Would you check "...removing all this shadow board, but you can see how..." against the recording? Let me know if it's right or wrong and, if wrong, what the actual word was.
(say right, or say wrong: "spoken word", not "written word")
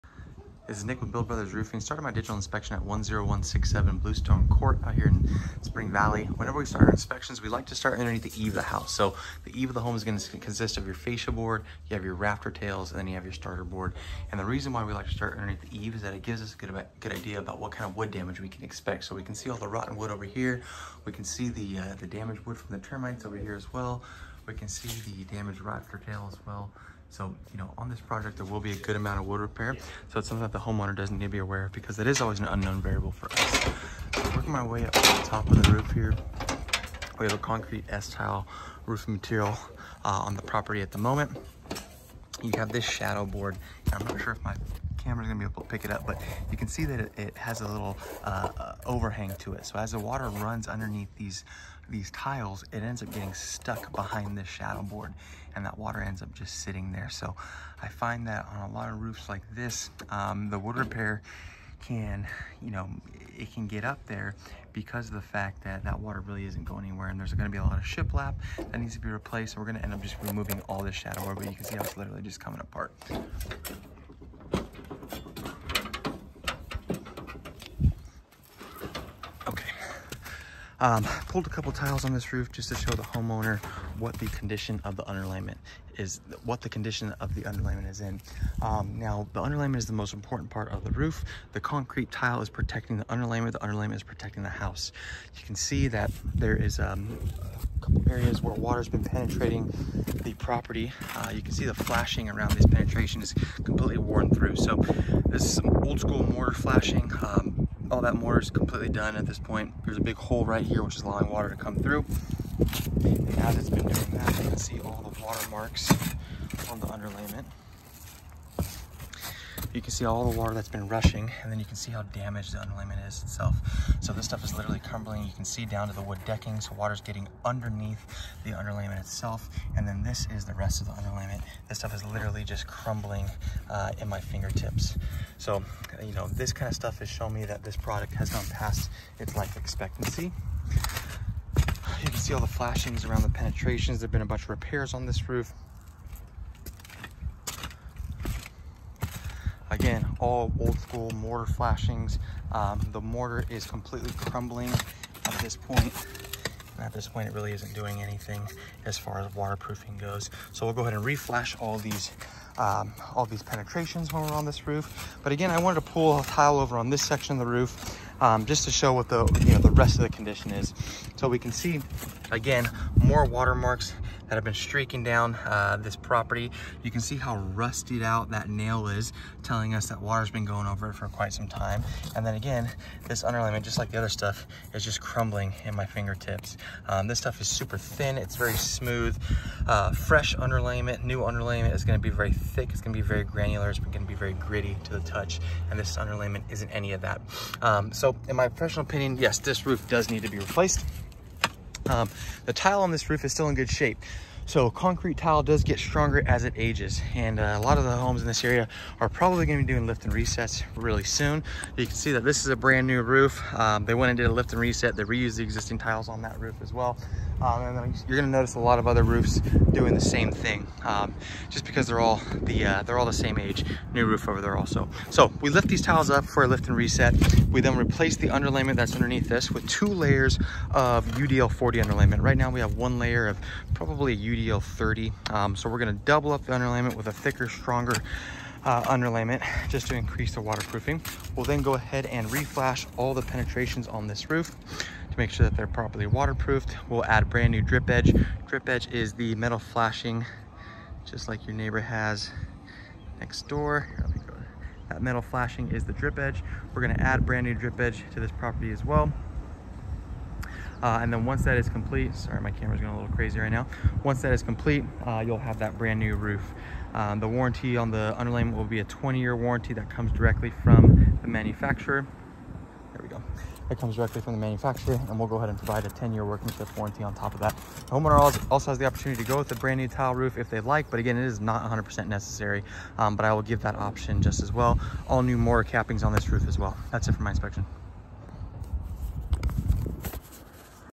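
right.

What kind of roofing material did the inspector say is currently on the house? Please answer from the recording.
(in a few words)
Concrete S-tile.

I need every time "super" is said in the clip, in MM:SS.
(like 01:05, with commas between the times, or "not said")
03:07.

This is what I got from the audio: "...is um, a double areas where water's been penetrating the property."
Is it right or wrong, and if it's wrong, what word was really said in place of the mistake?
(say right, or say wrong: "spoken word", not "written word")
wrong: "couple", not "double".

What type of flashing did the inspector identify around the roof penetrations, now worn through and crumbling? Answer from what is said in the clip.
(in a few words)
Mortar flashing.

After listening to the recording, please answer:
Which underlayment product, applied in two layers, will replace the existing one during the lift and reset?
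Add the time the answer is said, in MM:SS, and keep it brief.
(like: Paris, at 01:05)
UDL 40, at 03:51.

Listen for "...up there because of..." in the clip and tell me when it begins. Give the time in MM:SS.
01:03.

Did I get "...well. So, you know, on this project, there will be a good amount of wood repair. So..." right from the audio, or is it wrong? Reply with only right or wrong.
right.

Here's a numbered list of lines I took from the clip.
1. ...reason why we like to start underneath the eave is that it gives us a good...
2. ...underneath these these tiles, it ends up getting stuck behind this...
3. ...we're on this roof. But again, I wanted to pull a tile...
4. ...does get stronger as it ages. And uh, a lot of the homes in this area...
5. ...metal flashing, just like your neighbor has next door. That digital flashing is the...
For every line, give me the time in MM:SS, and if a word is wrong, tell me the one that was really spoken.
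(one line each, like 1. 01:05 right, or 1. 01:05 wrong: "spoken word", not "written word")
1. 00:14 right
2. 00:50 right
3. 02:44 right
4. 03:25 right
5. 04:09 wrong: "metal", not "digital".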